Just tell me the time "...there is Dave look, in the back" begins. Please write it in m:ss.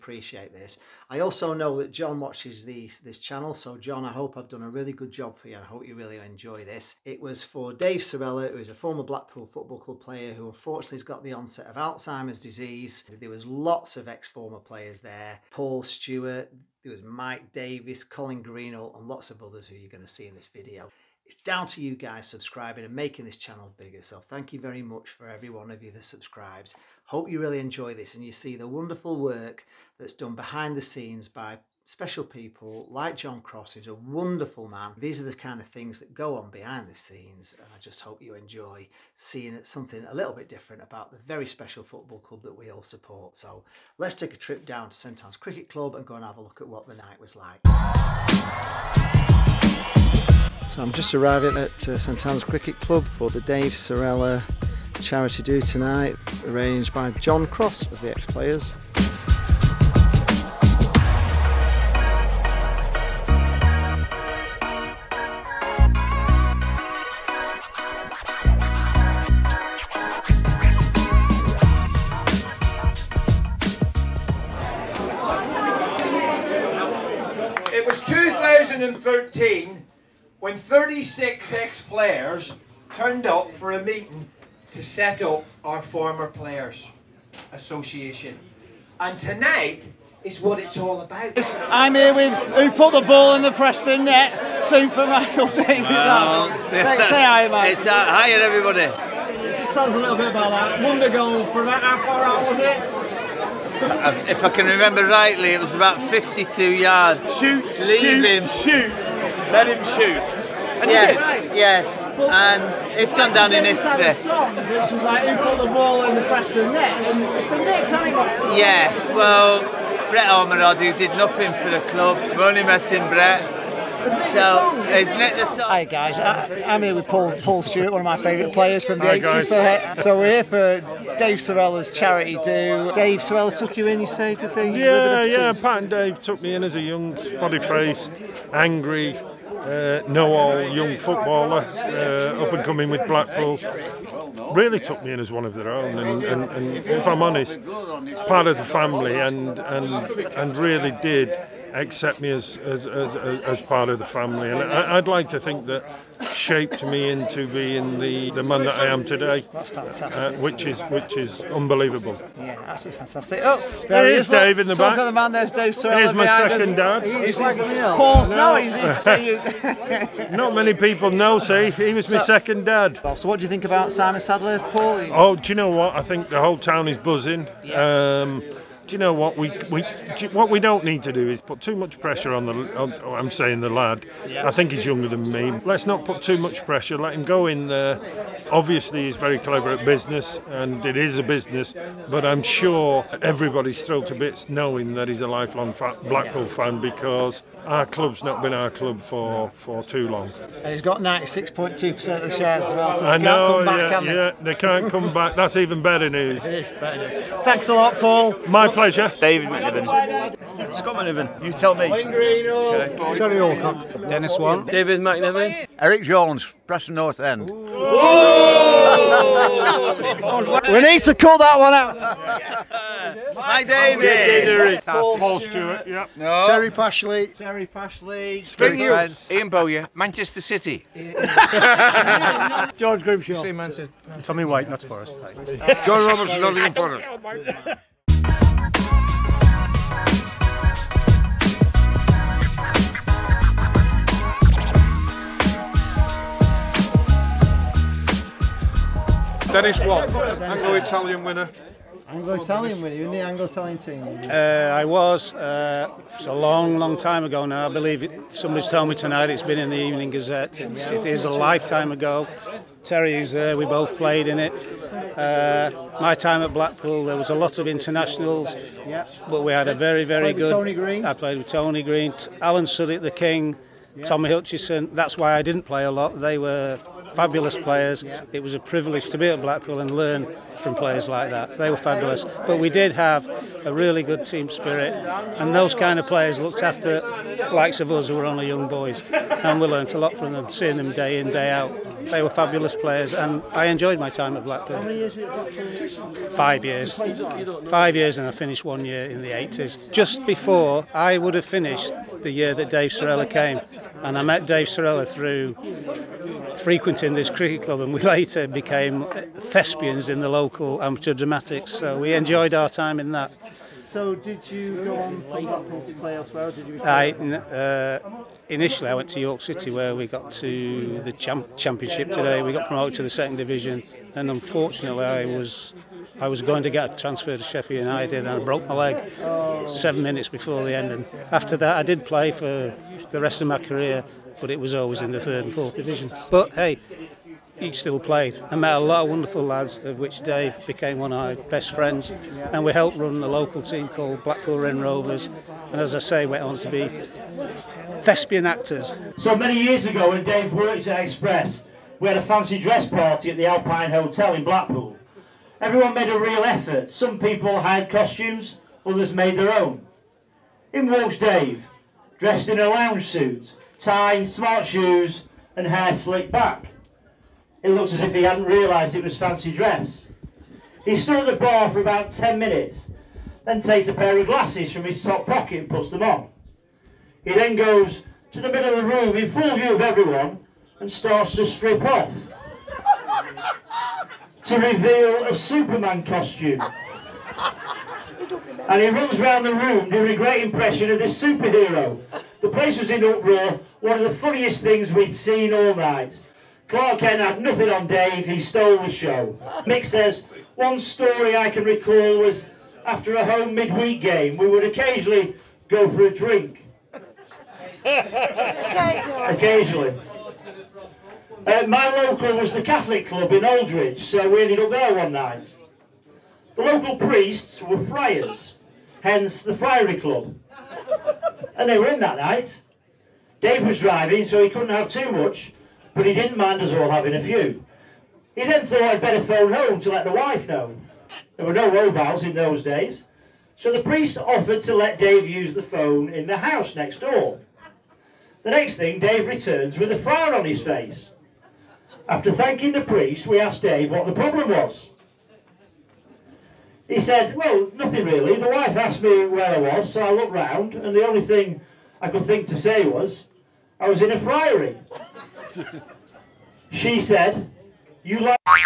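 2:44.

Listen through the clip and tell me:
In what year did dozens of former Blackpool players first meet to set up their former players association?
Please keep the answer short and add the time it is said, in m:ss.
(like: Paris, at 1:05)
2013, at 1:18.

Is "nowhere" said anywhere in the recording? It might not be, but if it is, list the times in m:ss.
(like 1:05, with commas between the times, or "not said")
not said.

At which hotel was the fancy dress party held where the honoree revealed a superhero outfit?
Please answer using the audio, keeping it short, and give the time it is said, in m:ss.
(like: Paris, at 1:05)
Alpine Hotel, at 5:53.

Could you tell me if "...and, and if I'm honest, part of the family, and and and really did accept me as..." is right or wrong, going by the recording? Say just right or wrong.
right.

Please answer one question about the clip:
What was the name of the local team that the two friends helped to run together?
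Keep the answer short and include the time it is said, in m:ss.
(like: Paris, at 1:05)
Blackpool Wren Rovers, at 5:44.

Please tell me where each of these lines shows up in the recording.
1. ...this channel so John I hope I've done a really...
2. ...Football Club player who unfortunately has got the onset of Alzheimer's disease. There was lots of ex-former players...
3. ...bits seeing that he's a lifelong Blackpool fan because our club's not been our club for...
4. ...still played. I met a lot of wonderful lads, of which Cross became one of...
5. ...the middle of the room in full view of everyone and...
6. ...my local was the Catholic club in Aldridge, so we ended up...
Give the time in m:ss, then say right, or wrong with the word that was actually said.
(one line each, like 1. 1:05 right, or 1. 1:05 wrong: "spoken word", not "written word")
1. 0:02 right
2. 0:09 right
3. 3:14 wrong: "knowing", not "seeing"
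4. 5:37 wrong: "Dave", not "Cross"
5. 6:18 right
6. 6:51 right.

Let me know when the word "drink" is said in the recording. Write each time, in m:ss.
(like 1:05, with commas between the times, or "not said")
6:46.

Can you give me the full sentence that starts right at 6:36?
Clark Kent had nothing on Dave, he stole the show.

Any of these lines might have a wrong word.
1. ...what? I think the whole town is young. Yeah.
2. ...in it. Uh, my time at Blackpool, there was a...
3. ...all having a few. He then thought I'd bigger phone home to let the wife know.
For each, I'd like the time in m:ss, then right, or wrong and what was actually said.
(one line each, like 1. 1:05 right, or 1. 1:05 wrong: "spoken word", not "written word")
1. 2:55 wrong: "buzzing", not "young"
2. 4:24 right
3. 7:06 wrong: "better", not "bigger".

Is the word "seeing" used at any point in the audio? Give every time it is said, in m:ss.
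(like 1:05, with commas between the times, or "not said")
0:39, 4:50.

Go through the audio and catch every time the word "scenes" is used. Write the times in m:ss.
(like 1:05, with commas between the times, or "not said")
0:30, 0:36.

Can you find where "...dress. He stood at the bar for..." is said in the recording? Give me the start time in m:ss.
6:09.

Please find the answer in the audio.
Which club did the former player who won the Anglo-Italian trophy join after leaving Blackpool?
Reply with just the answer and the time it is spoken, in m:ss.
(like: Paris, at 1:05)
York City, at 5:19.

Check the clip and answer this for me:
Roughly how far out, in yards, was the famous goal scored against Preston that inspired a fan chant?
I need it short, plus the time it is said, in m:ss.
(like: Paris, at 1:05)
52 yards, at 1:46.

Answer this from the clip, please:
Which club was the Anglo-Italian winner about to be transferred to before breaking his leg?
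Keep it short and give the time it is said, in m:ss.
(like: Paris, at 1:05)
Sheffield United, at 5:27.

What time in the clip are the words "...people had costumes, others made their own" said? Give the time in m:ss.
5:57.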